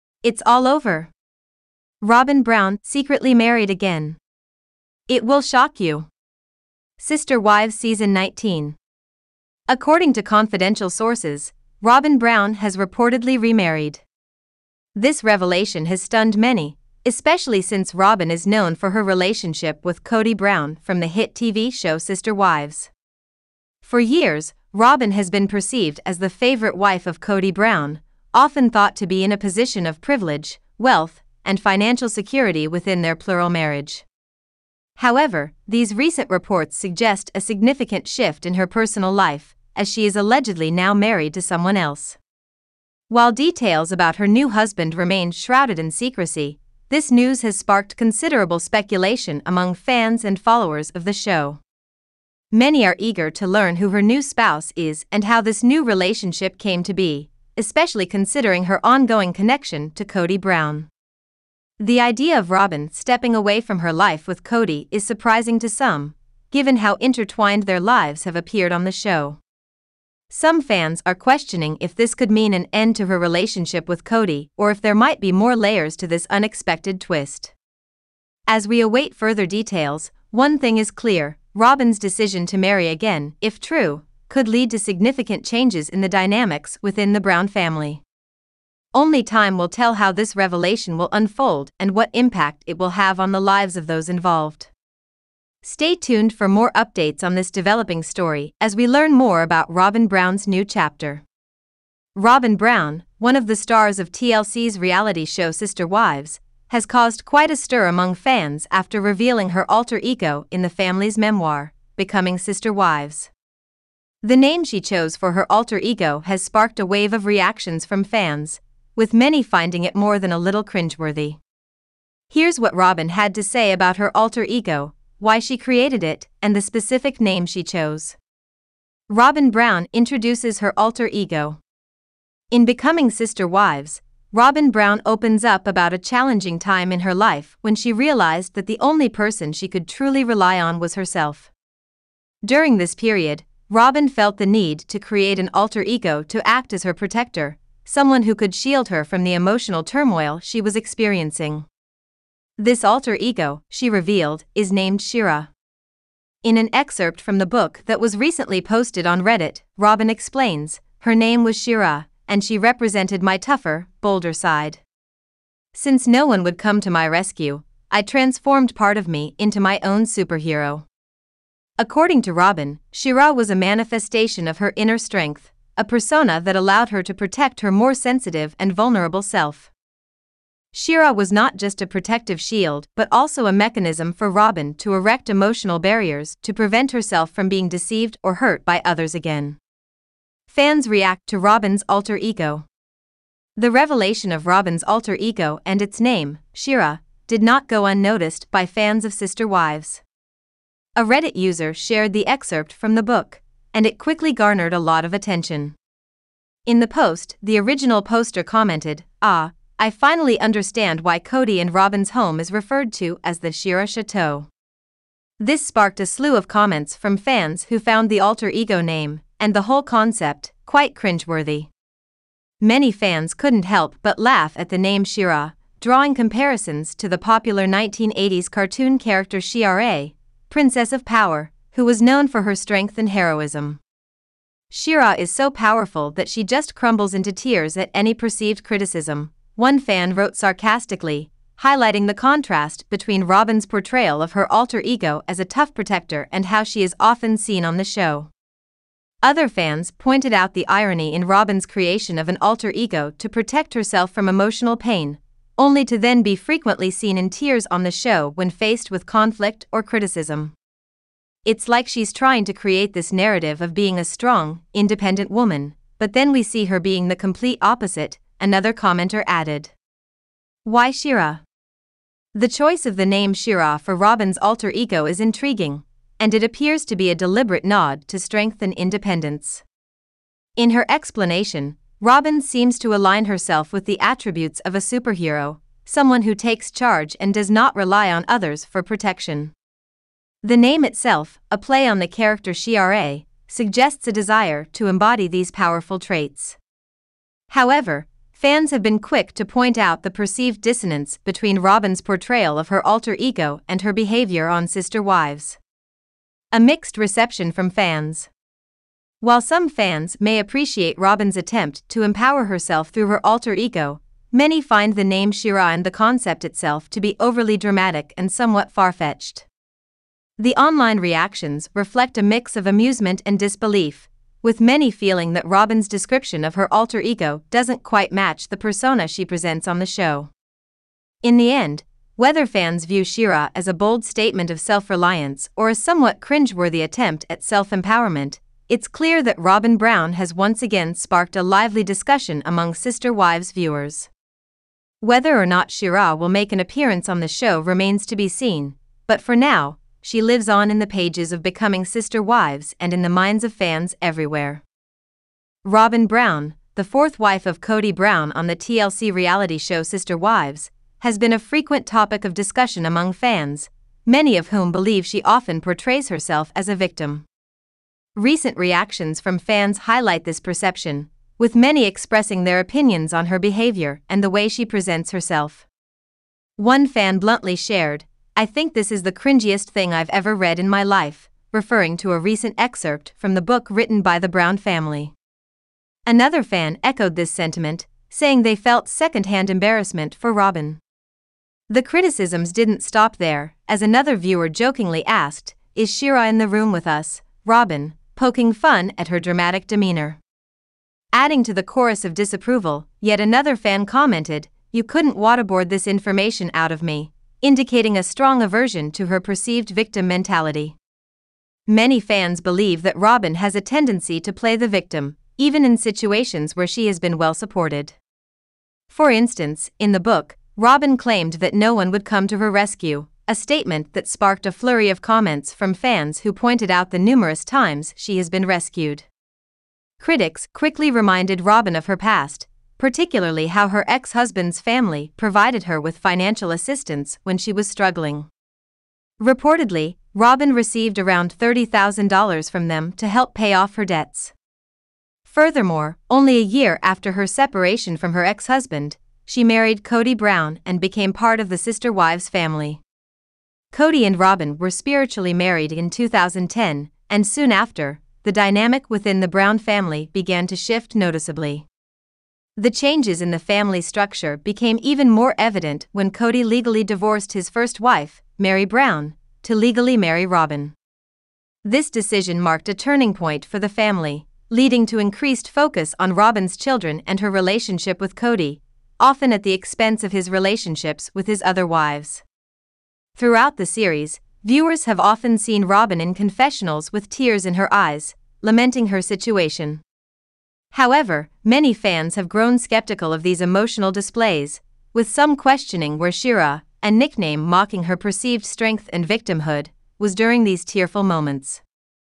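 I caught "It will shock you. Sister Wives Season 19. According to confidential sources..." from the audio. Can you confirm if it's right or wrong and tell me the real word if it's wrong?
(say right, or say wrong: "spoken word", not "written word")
right.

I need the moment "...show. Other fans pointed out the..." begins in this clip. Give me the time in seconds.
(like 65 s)
247 s.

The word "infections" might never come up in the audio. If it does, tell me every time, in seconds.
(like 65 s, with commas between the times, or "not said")
not said.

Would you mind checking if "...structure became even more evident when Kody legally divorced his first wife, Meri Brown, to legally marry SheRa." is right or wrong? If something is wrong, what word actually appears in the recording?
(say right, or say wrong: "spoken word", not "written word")
wrong: "Robyn", not "SheRa".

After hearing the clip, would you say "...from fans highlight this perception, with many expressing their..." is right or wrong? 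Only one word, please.
right.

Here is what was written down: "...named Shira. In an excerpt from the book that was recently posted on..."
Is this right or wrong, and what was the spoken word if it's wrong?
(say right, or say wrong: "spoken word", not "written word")
right.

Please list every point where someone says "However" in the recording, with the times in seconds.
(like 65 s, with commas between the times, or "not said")
34 s, 297 s, 490 s.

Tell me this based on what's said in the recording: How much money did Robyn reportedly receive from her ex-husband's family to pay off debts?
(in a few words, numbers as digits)
$30,000.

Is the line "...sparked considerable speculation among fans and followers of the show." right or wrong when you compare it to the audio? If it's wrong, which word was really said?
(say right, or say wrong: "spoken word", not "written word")
right.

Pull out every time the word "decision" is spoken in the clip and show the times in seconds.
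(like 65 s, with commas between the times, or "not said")
81 s, 471 s.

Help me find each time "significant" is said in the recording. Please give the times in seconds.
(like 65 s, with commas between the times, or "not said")
37 s, 84 s.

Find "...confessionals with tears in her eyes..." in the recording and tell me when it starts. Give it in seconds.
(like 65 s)
486 s.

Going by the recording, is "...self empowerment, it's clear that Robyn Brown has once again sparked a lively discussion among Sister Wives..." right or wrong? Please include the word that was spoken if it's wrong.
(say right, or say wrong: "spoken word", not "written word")
right.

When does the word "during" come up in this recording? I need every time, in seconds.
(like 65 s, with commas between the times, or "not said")
142 s, 500 s.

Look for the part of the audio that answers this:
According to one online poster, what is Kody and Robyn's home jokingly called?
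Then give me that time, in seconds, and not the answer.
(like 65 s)
213 s.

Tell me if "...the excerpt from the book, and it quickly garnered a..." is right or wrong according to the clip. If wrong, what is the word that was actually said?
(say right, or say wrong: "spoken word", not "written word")
right.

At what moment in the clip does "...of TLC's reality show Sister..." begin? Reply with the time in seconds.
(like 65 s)
103 s.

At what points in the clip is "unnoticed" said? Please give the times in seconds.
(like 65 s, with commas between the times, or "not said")
197 s.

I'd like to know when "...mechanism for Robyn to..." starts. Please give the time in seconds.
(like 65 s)
183 s.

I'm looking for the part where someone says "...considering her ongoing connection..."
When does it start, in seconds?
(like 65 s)
58 s.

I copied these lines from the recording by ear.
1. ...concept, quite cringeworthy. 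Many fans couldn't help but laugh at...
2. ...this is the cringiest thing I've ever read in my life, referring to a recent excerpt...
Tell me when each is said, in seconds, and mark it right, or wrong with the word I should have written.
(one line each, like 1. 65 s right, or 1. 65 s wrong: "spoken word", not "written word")
1. 219 s right
2. 378 s right.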